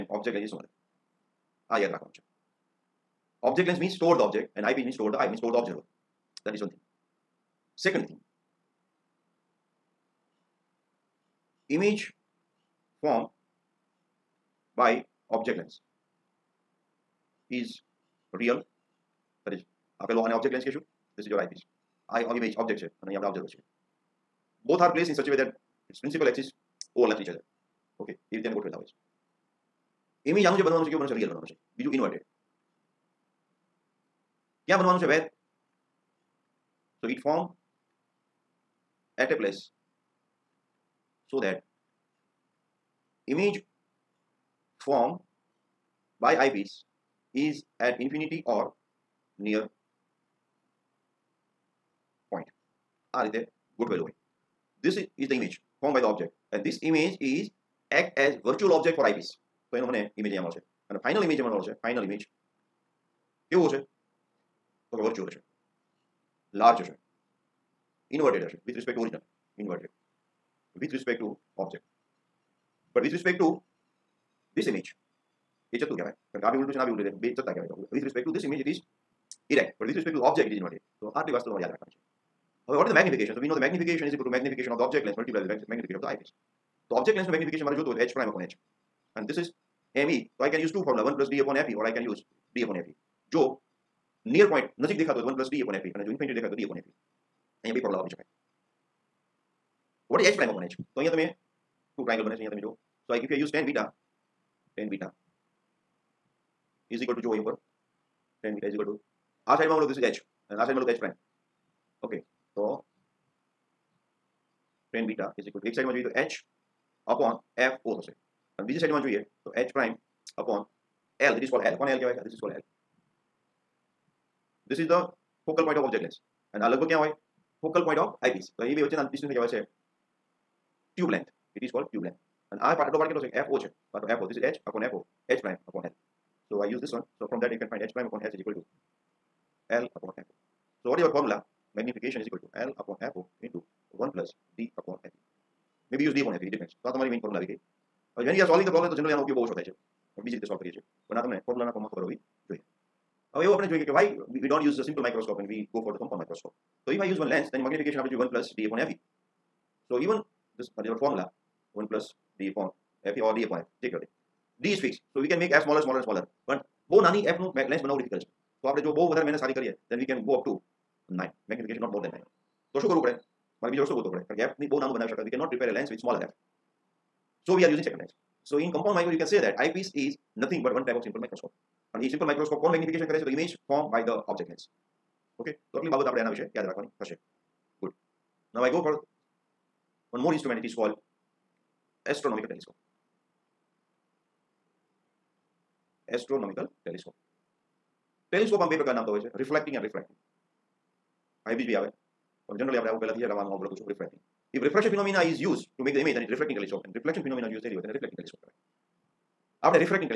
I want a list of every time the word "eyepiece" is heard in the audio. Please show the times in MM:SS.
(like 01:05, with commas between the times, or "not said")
00:21, 00:59, 01:26.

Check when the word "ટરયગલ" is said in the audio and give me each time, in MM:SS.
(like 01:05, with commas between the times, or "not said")
01:42.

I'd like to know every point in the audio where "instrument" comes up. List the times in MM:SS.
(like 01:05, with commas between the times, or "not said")
03:10.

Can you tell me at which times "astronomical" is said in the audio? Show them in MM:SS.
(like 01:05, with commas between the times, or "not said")
03:12, 03:16.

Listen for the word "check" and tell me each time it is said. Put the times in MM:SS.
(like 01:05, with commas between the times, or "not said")
02:43.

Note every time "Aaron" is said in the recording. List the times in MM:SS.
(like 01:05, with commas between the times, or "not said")
not said.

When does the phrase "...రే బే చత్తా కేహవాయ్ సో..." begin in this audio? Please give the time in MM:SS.
01:17.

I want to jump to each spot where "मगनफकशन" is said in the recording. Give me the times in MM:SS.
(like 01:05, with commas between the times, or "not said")
02:51, 03:02.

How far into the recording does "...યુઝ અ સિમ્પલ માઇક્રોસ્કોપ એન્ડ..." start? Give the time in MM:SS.
02:34.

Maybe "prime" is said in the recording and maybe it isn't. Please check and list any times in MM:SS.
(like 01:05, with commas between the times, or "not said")
01:28, 01:50, 01:59.